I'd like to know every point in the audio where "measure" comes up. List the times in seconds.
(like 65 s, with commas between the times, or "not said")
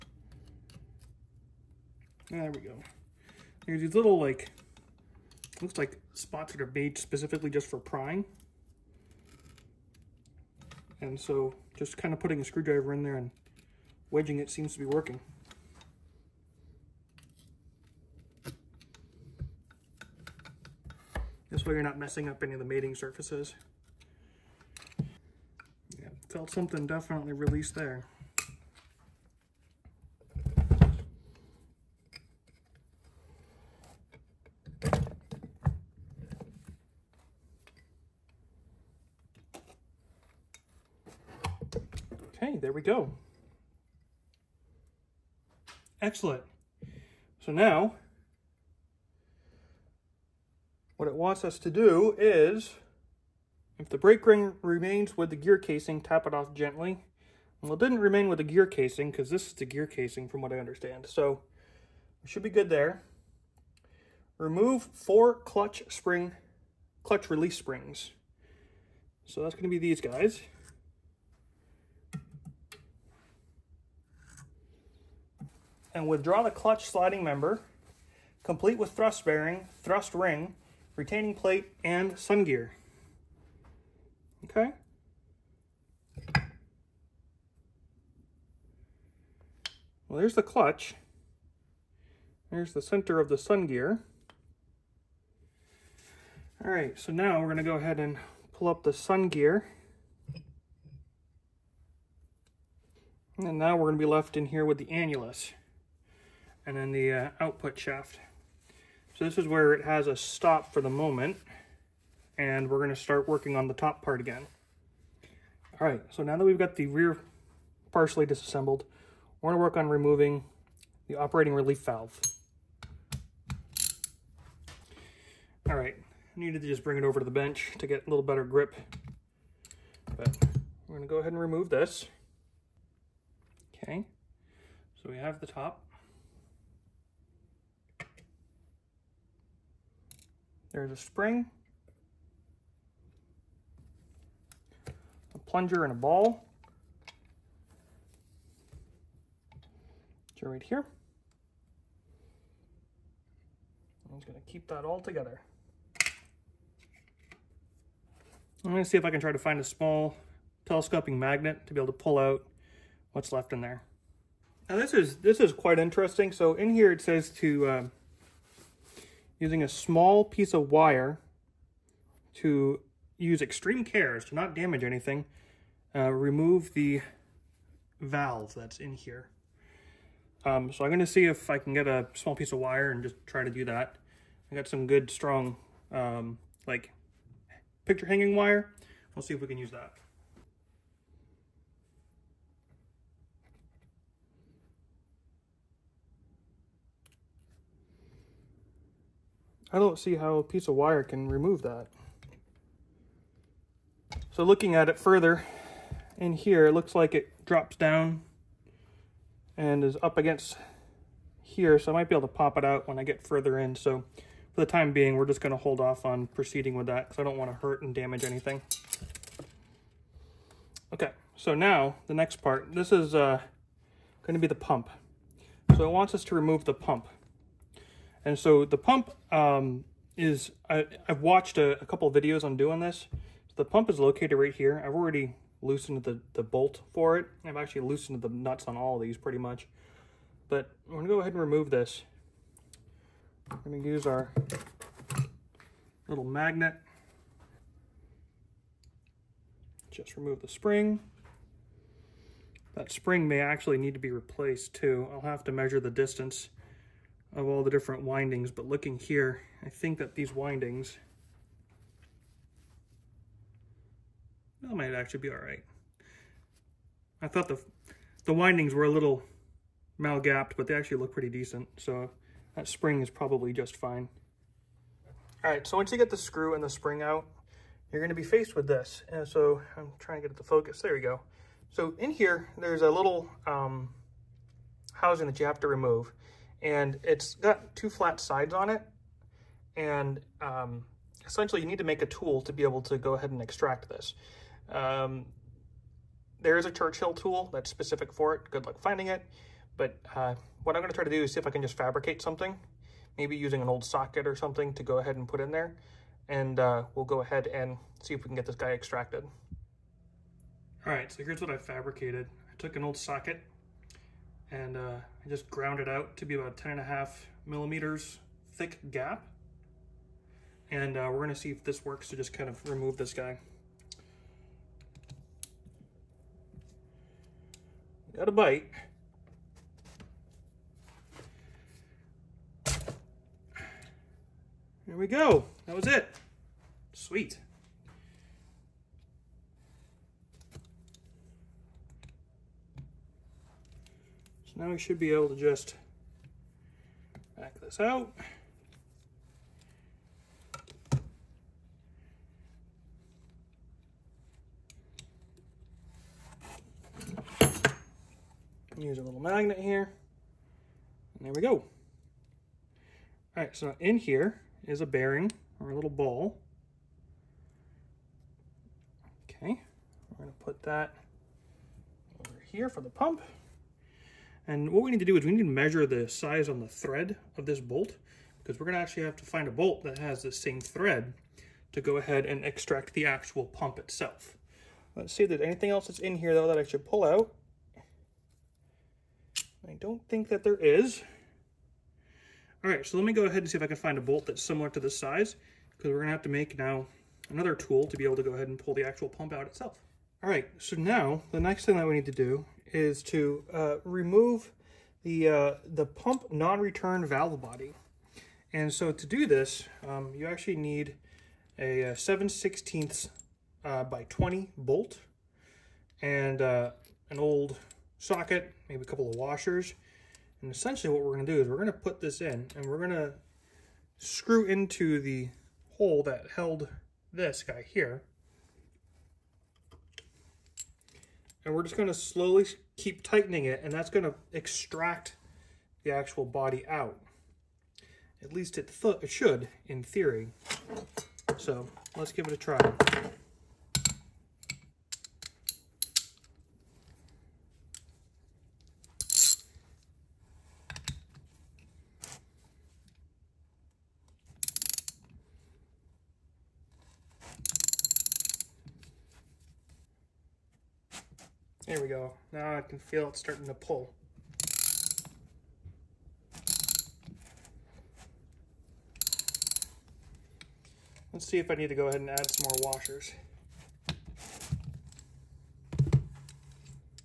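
255 s, 375 s.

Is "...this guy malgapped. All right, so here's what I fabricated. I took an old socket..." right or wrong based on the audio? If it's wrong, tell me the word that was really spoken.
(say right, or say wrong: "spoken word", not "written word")
wrong: "extracted", not "malgapped".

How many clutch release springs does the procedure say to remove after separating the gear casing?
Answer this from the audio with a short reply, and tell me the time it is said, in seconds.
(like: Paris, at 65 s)
4, at 64 s.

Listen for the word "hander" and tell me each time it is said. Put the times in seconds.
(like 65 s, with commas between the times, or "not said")
not said.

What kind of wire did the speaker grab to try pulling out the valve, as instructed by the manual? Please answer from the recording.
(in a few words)
Picture hanging wire.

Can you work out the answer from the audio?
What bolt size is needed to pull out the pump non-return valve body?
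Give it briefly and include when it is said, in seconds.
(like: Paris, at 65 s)
7/16 x 20, at 411 s.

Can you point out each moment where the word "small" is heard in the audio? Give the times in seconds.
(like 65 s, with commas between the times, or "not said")
159 s, 169 s, 182 s.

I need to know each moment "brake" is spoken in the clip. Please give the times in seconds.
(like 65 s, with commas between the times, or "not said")
53 s.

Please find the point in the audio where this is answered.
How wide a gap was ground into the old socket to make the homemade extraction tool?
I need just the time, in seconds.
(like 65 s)
316 s.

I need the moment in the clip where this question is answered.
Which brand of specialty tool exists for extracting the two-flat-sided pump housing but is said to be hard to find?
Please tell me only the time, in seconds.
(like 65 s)
296 s.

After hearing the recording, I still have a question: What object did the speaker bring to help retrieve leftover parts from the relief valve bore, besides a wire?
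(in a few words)
Telescoping magnet.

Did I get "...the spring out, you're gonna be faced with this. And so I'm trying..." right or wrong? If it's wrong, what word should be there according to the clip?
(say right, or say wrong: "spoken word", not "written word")
right.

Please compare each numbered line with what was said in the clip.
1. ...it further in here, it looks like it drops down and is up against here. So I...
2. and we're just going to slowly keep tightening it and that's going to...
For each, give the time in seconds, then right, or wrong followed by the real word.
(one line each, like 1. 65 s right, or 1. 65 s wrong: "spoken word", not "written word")
1. 204 s right
2. 431 s right.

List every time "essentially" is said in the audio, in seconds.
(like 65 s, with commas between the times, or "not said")
291 s, 420 s.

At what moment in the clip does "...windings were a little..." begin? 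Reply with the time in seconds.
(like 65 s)
268 s.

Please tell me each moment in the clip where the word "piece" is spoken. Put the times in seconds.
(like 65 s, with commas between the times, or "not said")
170 s, 182 s, 200 s.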